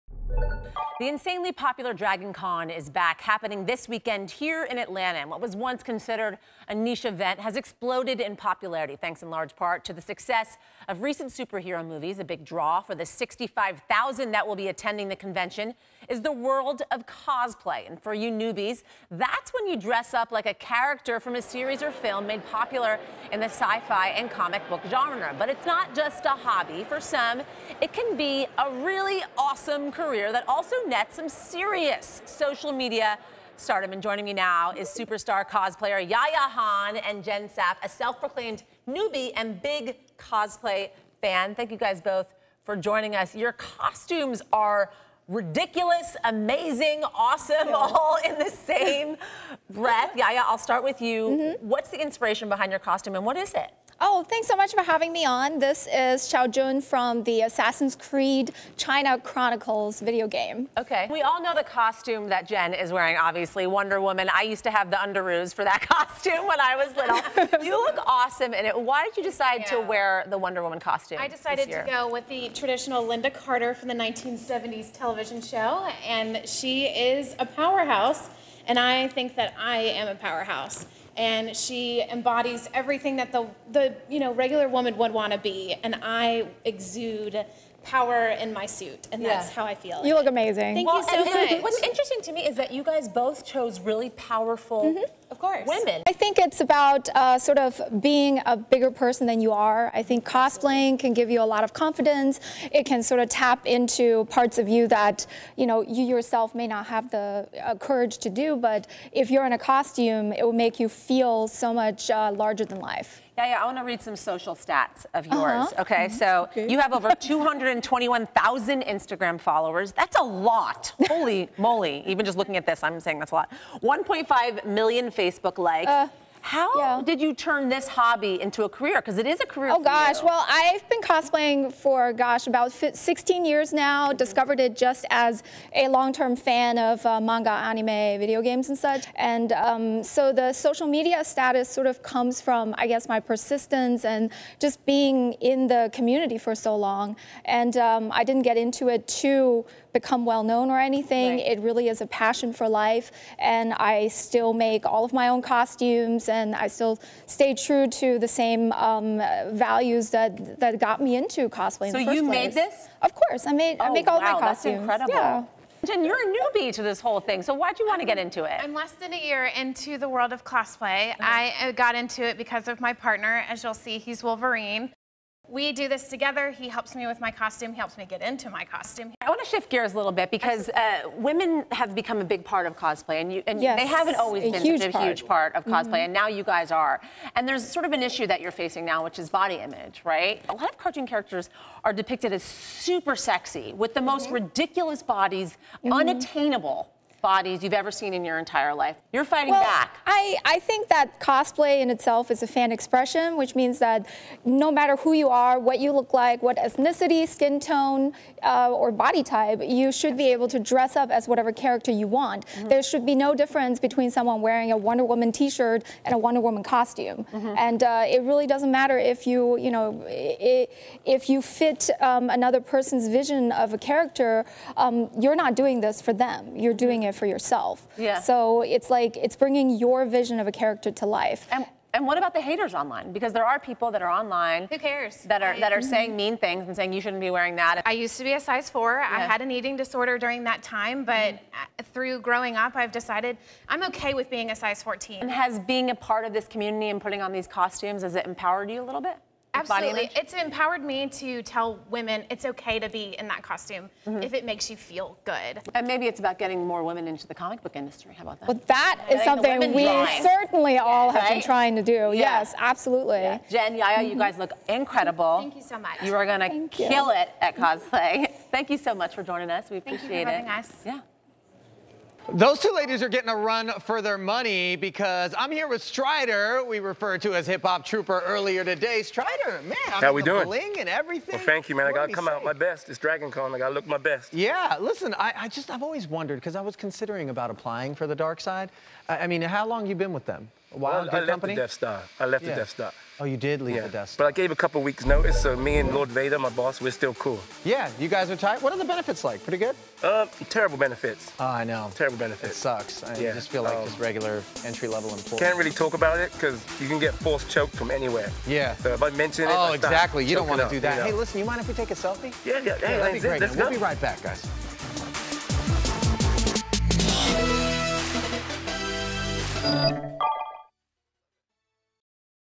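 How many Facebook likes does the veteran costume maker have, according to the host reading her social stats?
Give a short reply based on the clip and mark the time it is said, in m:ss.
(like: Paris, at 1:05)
1.5 million, at 2:04.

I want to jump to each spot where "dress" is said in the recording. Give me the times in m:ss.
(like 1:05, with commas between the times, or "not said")
0:19, 3:30.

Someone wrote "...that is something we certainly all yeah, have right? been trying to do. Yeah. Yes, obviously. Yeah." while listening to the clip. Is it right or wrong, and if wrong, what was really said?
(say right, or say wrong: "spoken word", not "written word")
wrong: "absolutely", not "obviously".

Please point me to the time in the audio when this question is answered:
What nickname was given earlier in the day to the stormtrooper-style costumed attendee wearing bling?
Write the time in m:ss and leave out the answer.
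4:37.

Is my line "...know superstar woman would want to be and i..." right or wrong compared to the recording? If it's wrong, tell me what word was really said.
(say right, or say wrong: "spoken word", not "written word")
wrong: "regular", not "superstar".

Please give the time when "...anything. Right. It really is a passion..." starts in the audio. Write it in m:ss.
2:30.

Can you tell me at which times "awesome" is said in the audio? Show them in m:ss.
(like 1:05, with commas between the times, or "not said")
0:29, 0:47, 1:08.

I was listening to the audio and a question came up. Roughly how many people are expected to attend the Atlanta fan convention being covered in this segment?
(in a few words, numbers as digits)
65,000.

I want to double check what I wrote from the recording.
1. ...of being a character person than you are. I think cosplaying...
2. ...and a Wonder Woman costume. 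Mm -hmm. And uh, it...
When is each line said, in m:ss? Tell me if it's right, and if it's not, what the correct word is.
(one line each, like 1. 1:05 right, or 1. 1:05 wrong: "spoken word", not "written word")
1. 1:37 wrong: "bigger", not "character"
2. 3:36 right.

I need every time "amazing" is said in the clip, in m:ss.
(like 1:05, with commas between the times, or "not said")
0:46, 1:30.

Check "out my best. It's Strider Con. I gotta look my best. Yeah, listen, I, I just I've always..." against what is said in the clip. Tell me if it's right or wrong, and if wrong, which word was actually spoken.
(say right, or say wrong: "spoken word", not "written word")
wrong: "Dragon", not "Strider".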